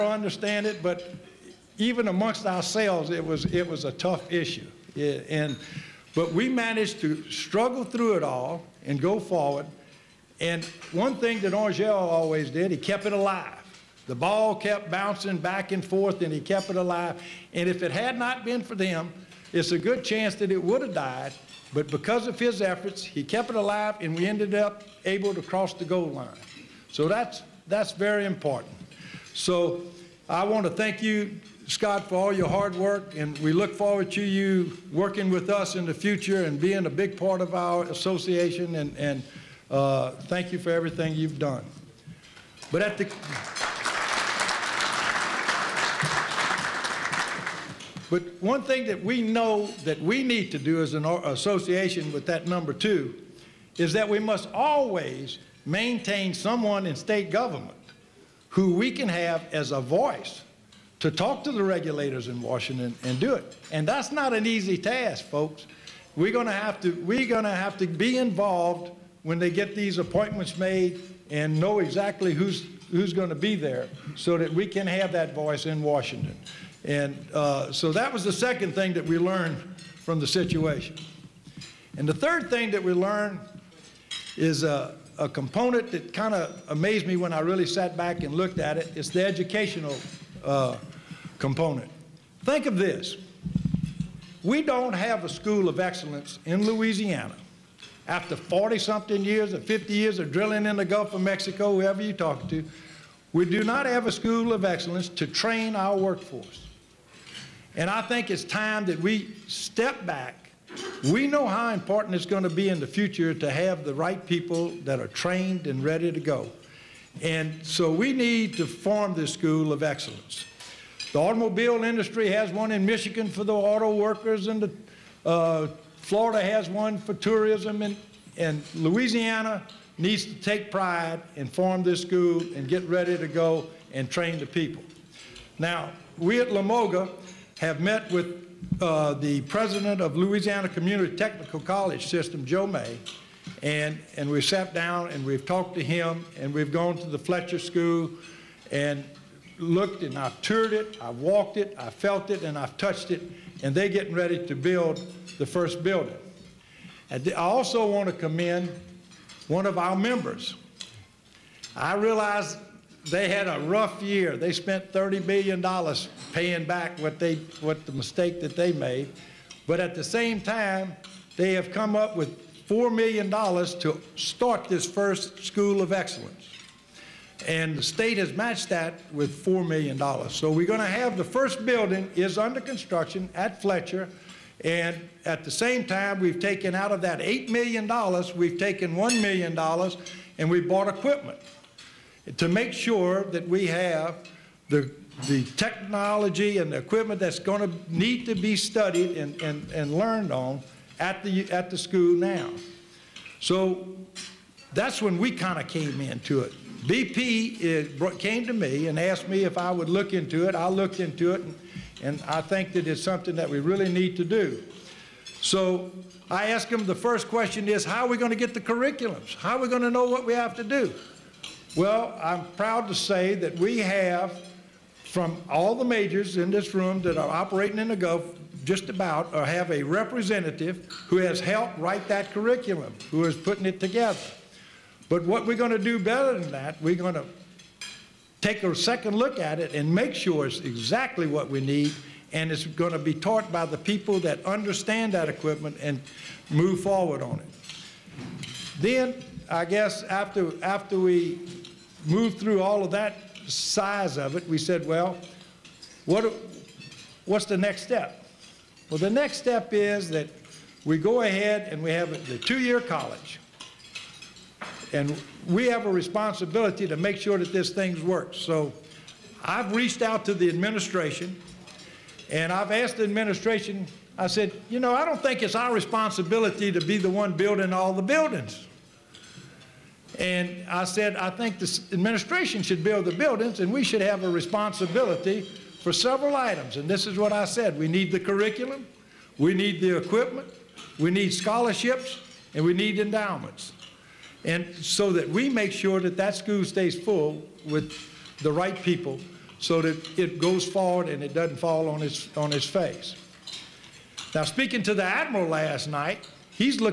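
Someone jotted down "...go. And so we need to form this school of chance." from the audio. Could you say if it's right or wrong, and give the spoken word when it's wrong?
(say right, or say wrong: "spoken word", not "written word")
wrong: "excellence", not "chance".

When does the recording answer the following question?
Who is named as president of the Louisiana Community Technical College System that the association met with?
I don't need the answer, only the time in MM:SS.
02:22.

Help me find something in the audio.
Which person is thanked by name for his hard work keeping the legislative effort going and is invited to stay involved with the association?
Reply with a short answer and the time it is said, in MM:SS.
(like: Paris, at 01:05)
Scott, at 00:31.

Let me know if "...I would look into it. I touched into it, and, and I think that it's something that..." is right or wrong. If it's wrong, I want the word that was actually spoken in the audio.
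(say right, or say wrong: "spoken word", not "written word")
wrong: "looked", not "touched".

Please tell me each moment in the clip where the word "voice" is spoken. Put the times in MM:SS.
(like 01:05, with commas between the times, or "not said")
00:59, 01:15.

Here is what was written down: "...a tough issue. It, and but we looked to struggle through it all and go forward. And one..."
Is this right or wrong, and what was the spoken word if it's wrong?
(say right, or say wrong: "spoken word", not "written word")
wrong: "managed", not "looked".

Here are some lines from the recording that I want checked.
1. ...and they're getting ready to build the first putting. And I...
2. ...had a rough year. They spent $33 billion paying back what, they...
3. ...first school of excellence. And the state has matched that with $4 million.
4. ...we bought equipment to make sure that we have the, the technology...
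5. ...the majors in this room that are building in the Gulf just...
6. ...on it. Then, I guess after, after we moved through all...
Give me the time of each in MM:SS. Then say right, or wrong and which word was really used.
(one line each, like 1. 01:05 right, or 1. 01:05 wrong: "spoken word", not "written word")
1. 02:33 wrong: "building", not "putting"
2. 02:43 wrong: "30", not "33"
3. 02:54 right
4. 03:10 right
5. 03:45 wrong: "operating", not "building"
6. 04:07 right.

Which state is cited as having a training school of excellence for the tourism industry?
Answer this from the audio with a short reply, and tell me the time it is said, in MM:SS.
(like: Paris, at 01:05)
Florida, at 02:06.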